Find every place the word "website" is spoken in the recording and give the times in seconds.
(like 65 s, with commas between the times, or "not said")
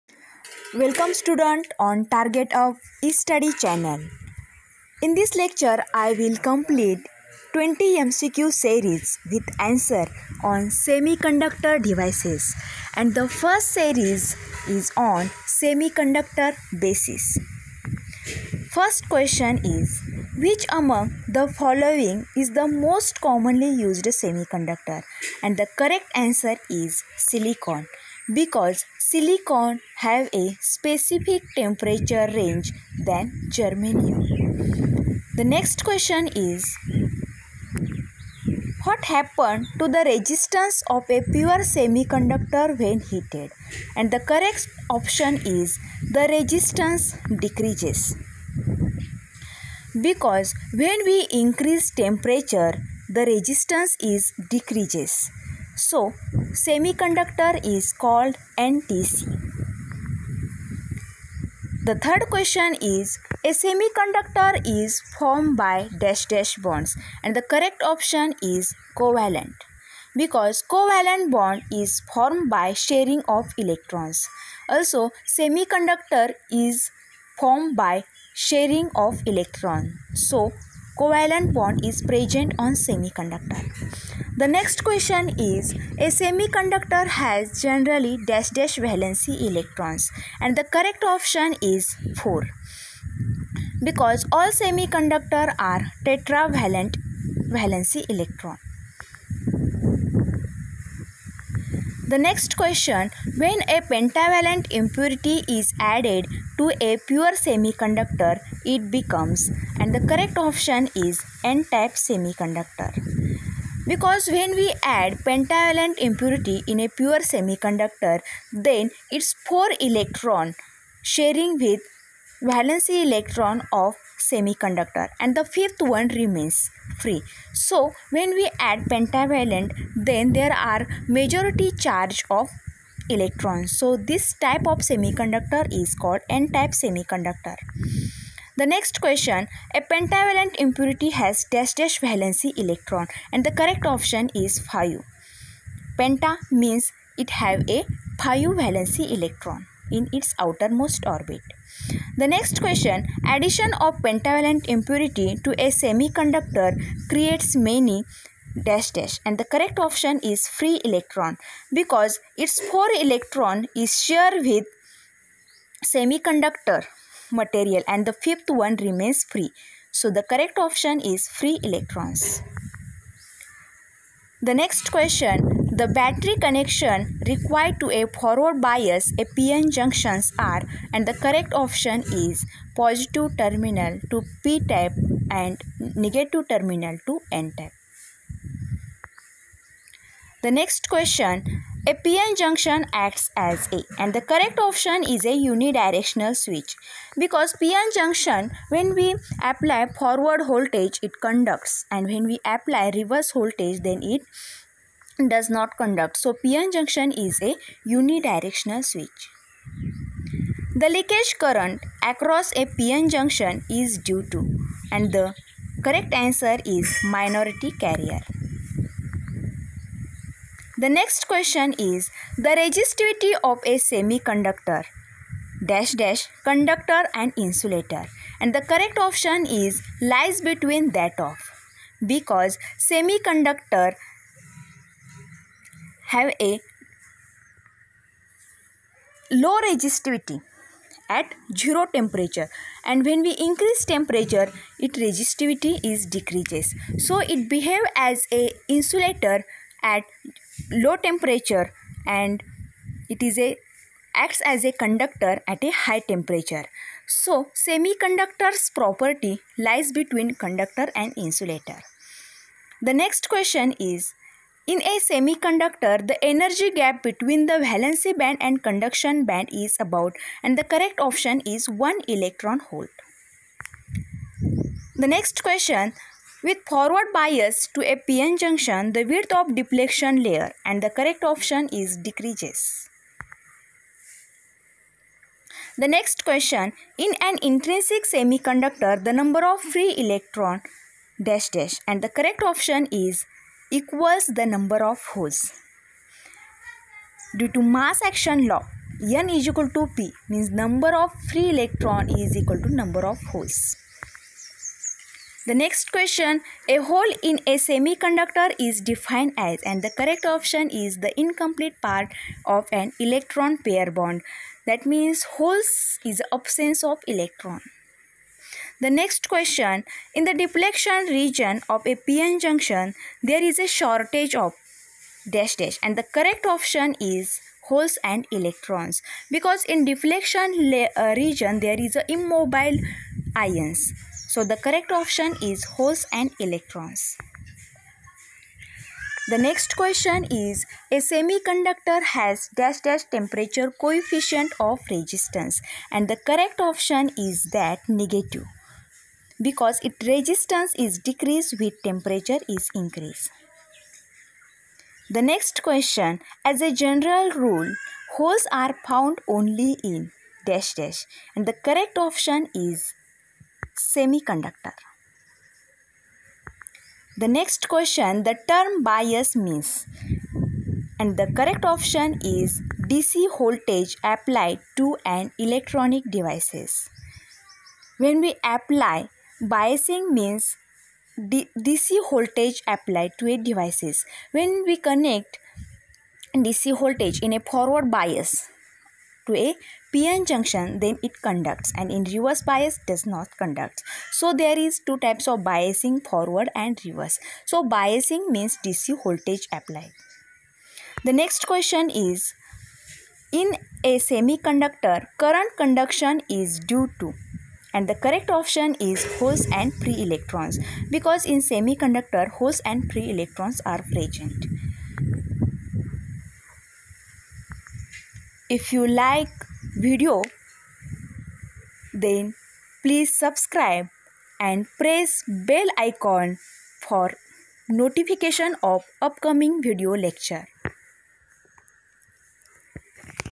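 not said.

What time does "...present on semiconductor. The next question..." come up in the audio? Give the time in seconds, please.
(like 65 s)
82 s.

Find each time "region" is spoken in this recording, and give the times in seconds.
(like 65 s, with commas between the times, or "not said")
321 s, 331 s.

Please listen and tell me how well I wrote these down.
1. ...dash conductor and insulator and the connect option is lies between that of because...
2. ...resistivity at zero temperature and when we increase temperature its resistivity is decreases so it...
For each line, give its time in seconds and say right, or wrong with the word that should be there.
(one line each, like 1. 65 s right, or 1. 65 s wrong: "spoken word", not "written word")
1. 226 s wrong: "correct", not "connect"
2. 239 s right.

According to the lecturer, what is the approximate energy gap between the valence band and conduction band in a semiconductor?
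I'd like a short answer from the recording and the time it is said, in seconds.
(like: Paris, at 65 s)
1 electron volt, at 271 s.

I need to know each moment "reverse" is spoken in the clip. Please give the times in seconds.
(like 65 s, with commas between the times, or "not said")
202 s, 392 s, 396 s.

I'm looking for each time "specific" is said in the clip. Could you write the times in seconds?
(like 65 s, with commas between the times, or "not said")
30 s.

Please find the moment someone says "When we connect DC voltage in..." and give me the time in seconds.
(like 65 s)
384 s.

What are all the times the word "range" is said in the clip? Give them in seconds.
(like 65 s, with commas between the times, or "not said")
32 s.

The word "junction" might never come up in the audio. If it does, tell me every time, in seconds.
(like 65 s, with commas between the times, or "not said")
179 s, 192 s, 197 s, 206 s, 213 s, 278 s, 322 s, 390 s.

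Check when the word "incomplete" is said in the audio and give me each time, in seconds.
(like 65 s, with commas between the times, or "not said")
311 s.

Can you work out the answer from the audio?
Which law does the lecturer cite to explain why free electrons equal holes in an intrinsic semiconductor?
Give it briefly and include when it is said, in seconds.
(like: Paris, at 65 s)
Mass action law, at 297 s.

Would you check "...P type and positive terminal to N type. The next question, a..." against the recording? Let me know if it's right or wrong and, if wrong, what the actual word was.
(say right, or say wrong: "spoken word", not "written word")
wrong: "negative", not "positive".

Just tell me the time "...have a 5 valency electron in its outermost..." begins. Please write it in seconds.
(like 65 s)
147 s.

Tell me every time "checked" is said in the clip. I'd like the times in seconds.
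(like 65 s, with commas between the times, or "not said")
not said.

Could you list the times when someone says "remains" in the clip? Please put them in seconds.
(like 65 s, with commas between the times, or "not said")
126 s, 168 s.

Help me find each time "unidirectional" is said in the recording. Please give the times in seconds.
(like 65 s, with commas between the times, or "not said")
195 s, 207 s.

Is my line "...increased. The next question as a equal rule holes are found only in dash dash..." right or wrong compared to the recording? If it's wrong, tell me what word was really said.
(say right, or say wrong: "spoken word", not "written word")
wrong: "general", not "equal".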